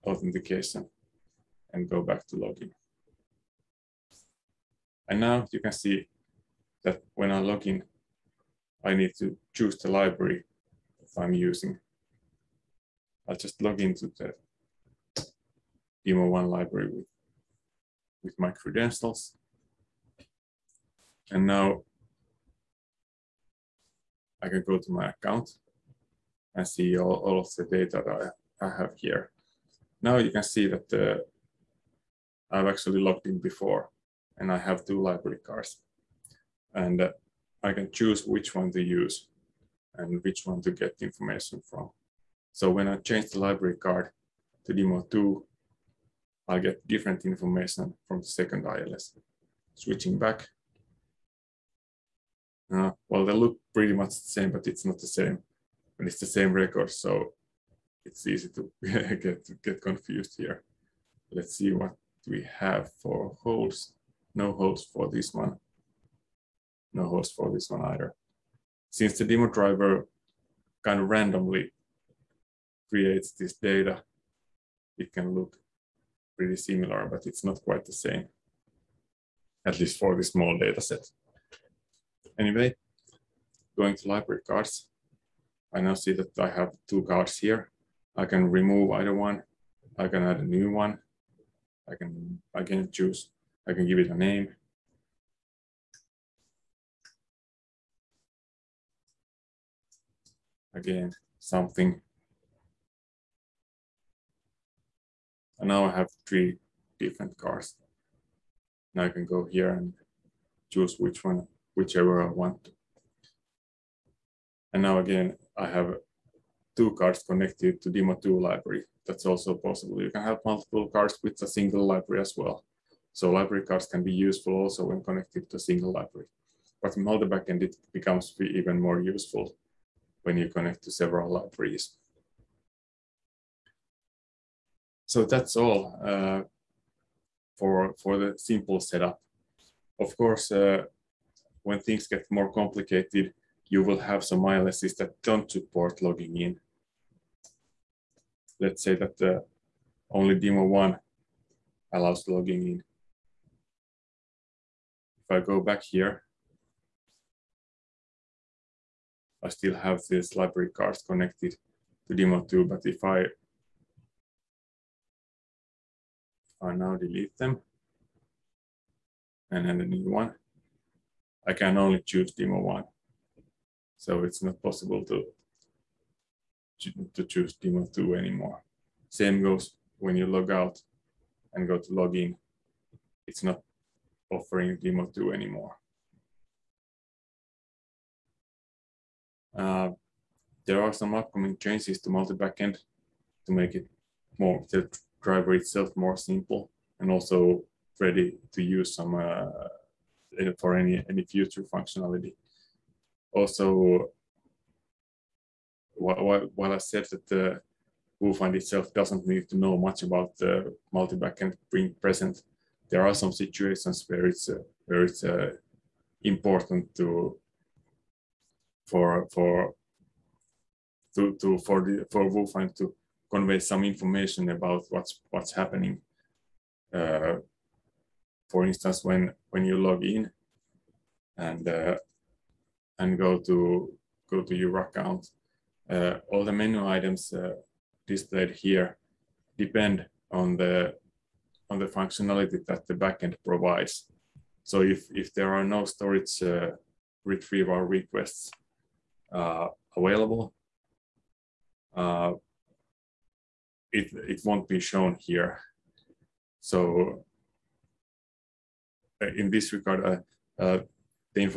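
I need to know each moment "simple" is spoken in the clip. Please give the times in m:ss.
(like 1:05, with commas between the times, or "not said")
2:18, 3:16.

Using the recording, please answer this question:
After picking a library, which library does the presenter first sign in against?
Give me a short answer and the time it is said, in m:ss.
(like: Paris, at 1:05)
Demo1, at 0:16.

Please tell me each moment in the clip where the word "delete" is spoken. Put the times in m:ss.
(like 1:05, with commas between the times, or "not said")
2:46.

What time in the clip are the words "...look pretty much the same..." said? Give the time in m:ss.
0:53.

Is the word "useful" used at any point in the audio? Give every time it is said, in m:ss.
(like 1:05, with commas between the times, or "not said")
2:04, 2:09.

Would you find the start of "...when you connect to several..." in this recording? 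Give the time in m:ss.
2:10.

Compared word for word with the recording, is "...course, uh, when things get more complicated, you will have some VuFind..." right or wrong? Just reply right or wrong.
wrong.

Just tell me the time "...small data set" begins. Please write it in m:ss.
1:20.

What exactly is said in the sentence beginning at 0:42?
So when I change the library card to Demo2, I'll get different information from the second ILS.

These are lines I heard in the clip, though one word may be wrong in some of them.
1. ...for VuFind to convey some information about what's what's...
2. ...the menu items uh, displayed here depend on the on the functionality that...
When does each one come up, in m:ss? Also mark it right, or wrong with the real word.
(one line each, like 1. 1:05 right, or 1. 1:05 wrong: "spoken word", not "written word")
1. 3:42 right
2. 3:56 right.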